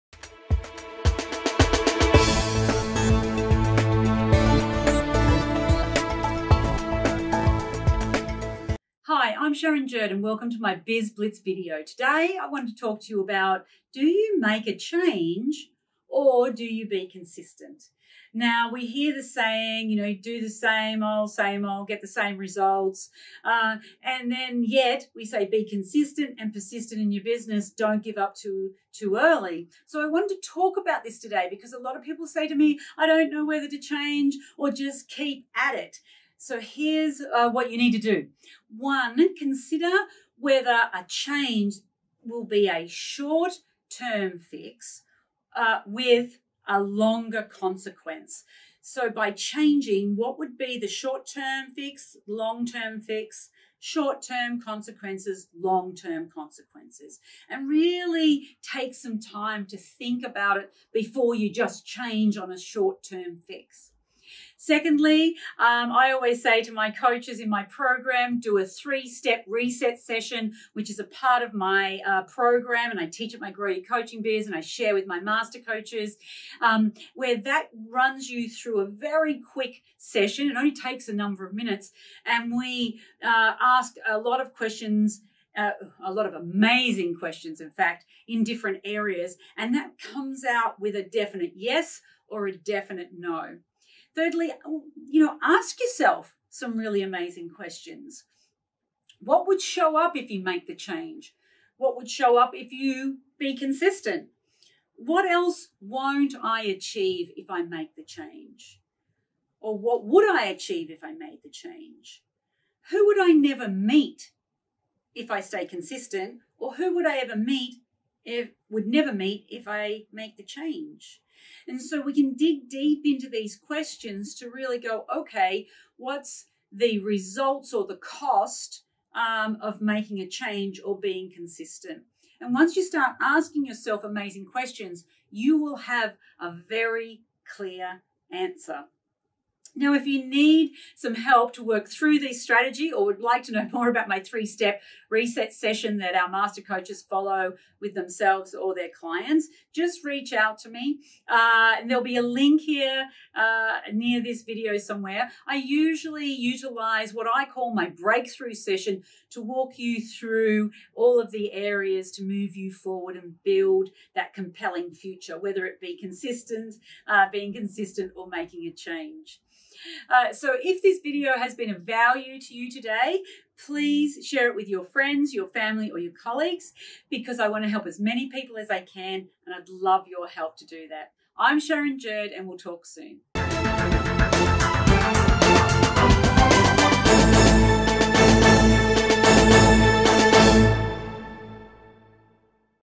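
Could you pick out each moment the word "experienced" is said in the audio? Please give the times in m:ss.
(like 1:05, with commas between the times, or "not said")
not said.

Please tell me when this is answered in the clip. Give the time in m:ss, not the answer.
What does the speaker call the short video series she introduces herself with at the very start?
0:10.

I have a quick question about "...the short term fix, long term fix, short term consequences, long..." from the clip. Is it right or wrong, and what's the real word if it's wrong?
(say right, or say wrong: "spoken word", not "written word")
right.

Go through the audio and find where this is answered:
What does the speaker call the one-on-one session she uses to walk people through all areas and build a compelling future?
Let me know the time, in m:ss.
2:37.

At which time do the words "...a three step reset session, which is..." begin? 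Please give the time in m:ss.
1:08.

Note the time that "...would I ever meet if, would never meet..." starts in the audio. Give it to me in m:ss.
1:56.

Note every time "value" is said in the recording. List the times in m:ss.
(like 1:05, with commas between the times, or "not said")
2:51.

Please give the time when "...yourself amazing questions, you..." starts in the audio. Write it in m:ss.
2:13.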